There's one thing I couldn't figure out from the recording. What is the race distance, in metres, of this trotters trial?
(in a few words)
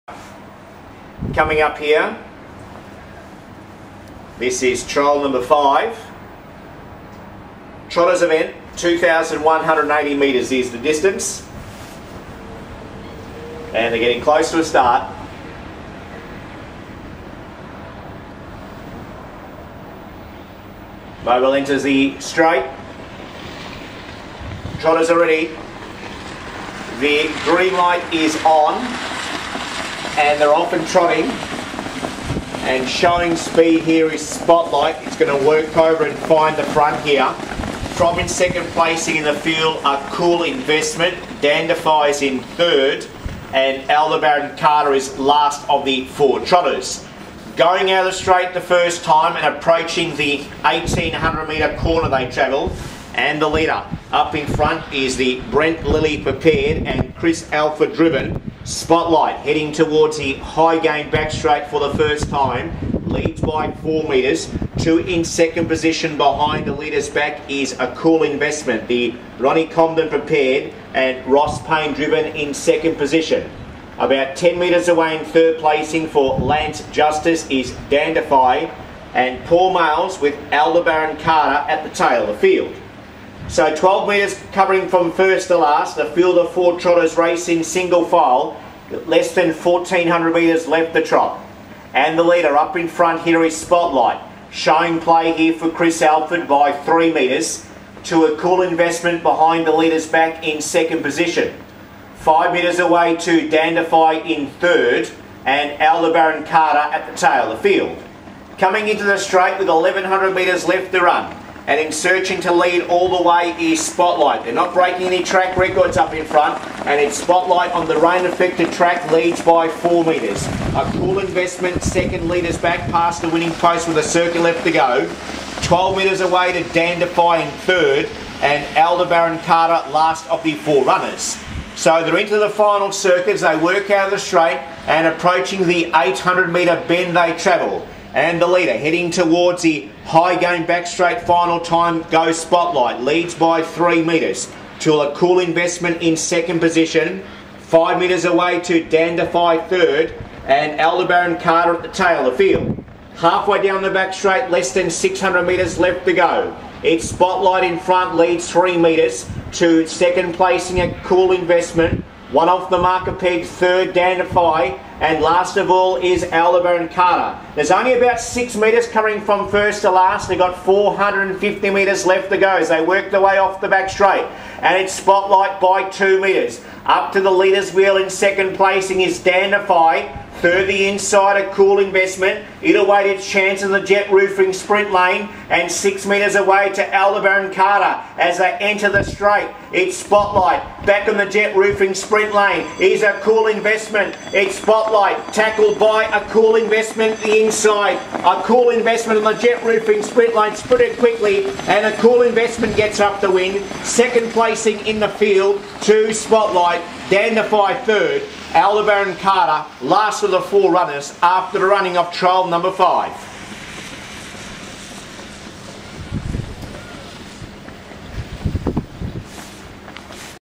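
2,180 metres.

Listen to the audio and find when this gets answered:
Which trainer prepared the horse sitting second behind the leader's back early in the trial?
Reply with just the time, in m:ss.
1:09.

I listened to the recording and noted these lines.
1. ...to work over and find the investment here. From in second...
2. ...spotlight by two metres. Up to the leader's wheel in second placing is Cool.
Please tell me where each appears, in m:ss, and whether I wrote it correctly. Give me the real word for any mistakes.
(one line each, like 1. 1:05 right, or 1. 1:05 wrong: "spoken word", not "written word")
1. 0:35 wrong: "front", not "investment"
2. 2:54 wrong: "Dandify", not "Cool".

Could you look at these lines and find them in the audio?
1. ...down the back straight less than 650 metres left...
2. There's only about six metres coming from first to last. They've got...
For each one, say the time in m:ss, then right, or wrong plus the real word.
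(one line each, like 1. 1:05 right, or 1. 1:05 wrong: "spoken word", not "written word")
1. 2:33 wrong: "600", not "650"
2. 2:47 right.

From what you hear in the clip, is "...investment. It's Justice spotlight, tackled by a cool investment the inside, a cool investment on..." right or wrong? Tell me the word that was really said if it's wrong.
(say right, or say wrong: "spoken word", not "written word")
wrong: "Spotlight", not "Justice".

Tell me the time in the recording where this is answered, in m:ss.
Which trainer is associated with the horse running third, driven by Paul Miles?
1:16.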